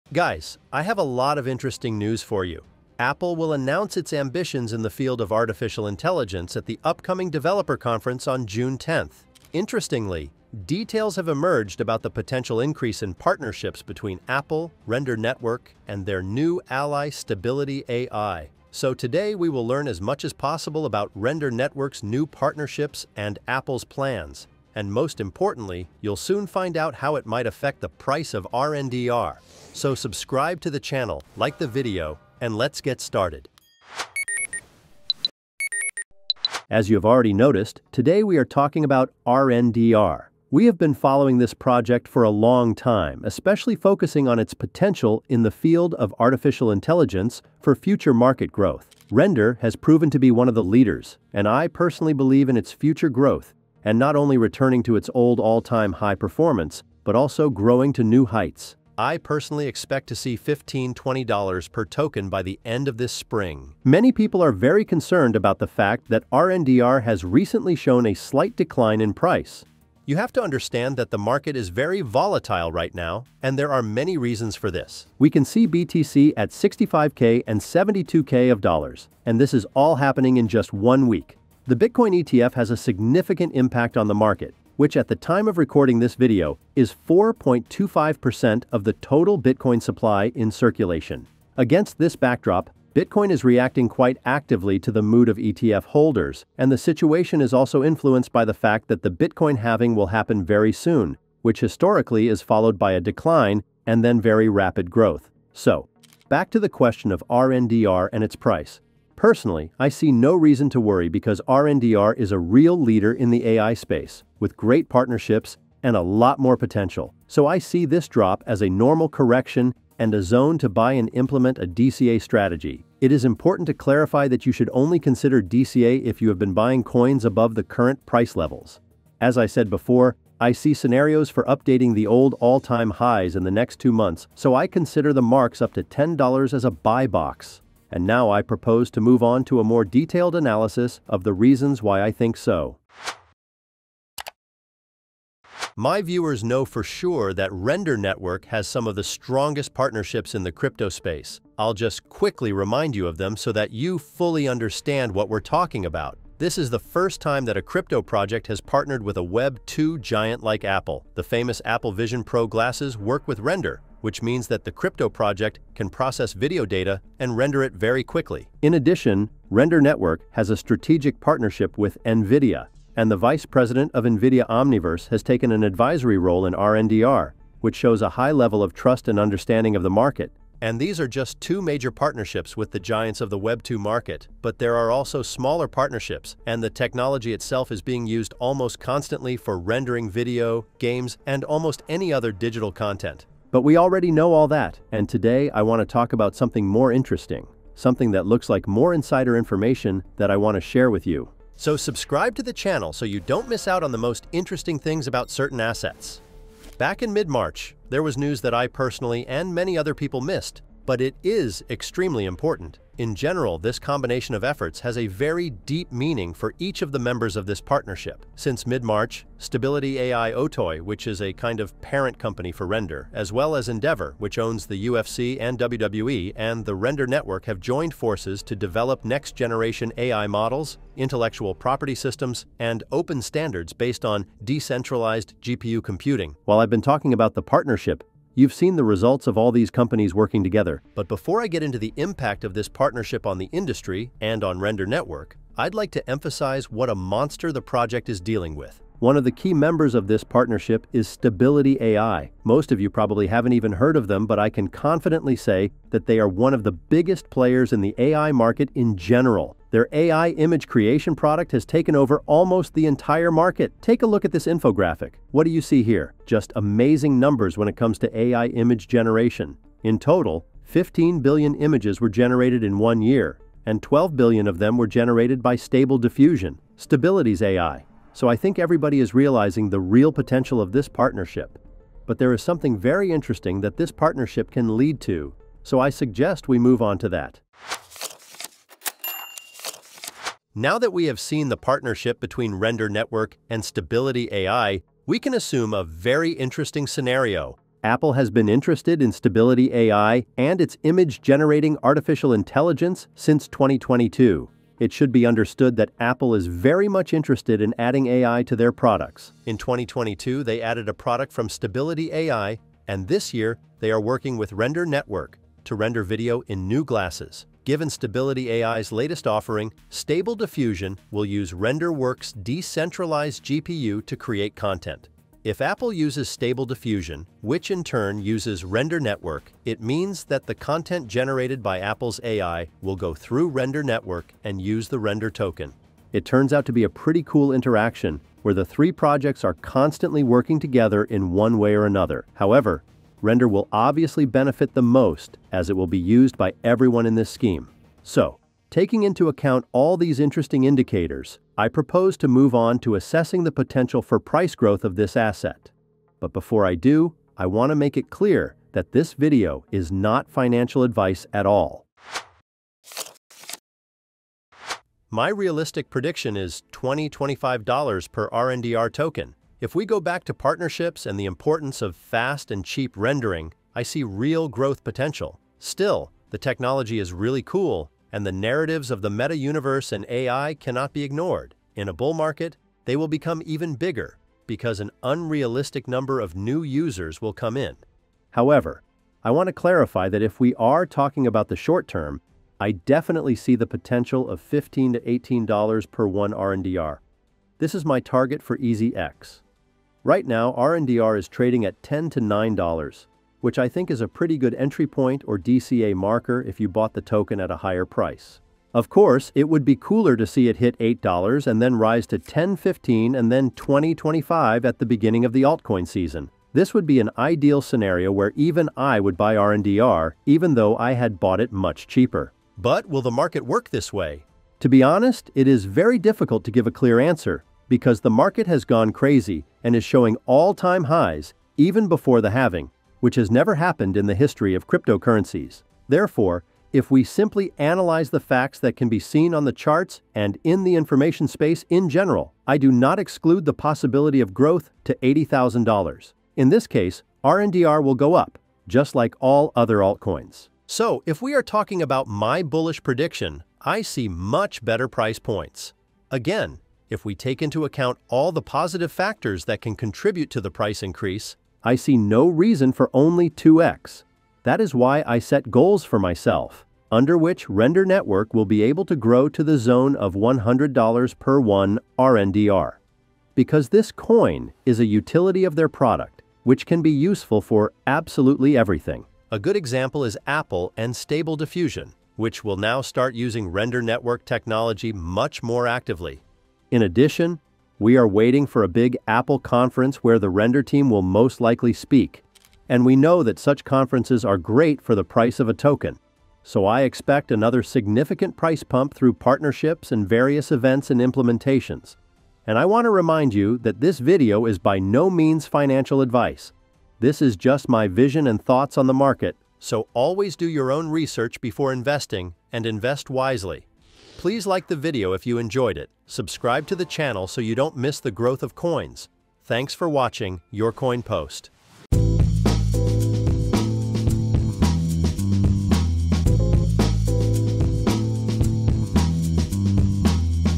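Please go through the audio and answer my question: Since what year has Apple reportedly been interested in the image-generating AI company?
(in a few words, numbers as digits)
2022.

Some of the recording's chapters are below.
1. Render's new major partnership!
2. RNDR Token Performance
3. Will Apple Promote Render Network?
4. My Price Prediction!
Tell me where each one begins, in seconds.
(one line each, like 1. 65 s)
1. 145 s
2. 36 s
3. 291 s
4. 365 s.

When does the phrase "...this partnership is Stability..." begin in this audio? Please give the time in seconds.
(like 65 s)
250 s.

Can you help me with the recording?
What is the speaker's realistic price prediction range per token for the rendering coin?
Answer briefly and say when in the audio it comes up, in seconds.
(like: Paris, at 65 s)
$20-$25, at 366 s.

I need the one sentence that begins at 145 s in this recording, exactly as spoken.
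My viewers know for sure that Render Network has some of the strongest partnerships in the crypto space.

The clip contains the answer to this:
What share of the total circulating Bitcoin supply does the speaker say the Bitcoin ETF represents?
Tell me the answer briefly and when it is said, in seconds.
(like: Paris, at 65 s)
4.25%, at 87 s.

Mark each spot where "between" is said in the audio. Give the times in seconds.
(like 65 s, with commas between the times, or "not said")
13 s, 292 s.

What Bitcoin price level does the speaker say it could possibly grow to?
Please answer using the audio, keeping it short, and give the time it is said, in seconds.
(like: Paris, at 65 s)
$80,000, at 445 s.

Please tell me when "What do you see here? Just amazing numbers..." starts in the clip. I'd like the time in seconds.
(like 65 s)
265 s.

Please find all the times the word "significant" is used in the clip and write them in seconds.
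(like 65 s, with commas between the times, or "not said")
82 s, 497 s.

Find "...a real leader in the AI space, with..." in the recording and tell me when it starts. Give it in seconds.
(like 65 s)
112 s.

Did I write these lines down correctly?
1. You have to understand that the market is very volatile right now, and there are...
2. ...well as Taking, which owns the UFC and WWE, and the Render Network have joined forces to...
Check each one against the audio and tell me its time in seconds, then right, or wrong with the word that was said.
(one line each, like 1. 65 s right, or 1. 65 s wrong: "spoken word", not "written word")
1. 70 s right
2. 223 s wrong: "Endeavor", not "Taking".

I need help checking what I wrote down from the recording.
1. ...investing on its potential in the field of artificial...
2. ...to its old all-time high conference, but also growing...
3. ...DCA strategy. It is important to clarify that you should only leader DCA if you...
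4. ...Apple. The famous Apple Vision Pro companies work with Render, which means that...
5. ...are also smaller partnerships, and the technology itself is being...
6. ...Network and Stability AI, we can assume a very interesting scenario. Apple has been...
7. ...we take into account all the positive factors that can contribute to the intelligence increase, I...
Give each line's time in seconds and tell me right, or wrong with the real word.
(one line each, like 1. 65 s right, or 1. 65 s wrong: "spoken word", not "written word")
1. 43 s wrong: "focusing", not "investing"
2. 54 s wrong: "performance", not "conference"
3. 121 s wrong: "consider", not "leader"
4. 160 s wrong: "glasses", not "companies"
5. 184 s right
6. 292 s right
7. 457 s wrong: "price", not "intelligence".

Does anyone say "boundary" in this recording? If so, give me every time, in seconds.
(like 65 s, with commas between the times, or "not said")
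not said.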